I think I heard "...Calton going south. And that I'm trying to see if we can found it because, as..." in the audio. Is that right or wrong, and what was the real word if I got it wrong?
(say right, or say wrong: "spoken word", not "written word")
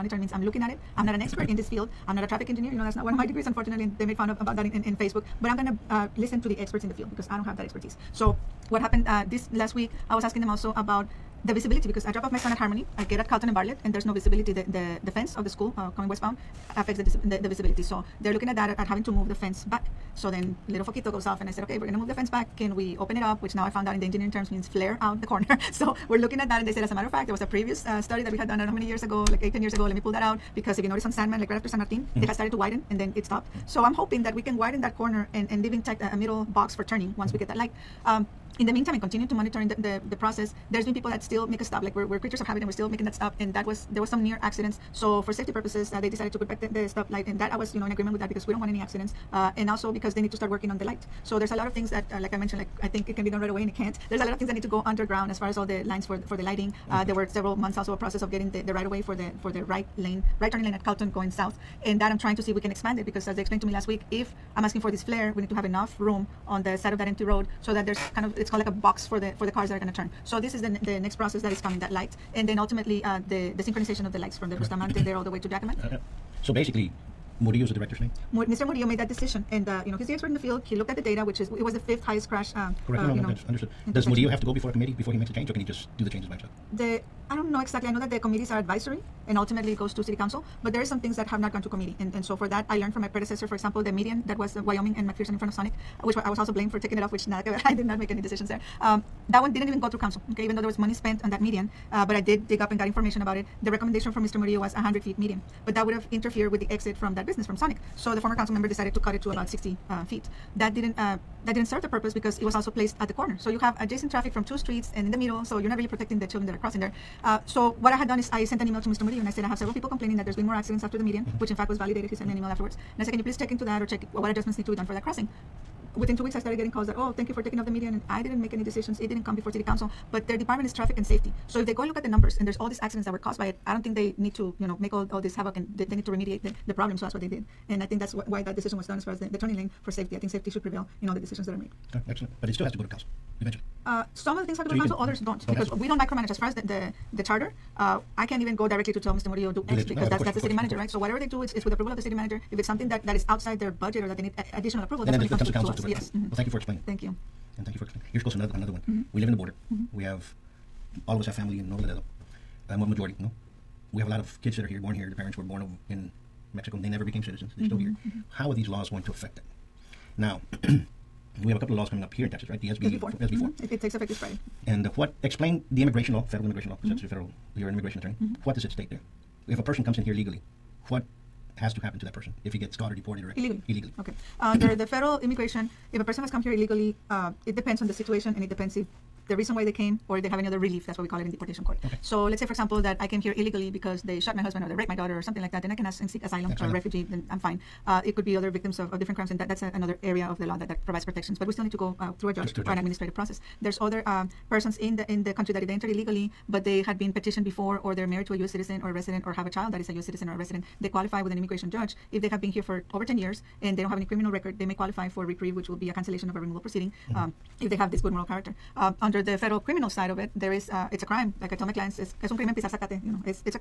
wrong: "expand", not "found".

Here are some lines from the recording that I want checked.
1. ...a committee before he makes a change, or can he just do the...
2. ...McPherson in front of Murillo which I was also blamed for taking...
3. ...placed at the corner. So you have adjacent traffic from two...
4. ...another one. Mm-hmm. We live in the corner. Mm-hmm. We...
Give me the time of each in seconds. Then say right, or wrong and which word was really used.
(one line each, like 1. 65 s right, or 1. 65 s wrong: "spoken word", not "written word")
1. 84 s right
2. 95 s wrong: "Sonic", not "Murillo"
3. 112 s right
4. 158 s wrong: "border", not "corner".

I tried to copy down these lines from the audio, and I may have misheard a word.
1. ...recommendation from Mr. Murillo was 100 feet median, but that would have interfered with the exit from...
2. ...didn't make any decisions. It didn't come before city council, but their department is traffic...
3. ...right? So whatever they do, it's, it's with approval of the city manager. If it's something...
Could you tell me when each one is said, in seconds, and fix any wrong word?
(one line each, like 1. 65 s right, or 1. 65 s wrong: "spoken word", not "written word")
1. 103 s right
2. 128 s right
3. 150 s right.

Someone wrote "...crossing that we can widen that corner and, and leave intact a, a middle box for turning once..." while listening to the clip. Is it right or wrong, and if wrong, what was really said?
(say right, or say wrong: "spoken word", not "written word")
wrong: "hoping", not "crossing".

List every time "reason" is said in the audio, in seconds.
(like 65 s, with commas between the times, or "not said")
189 s.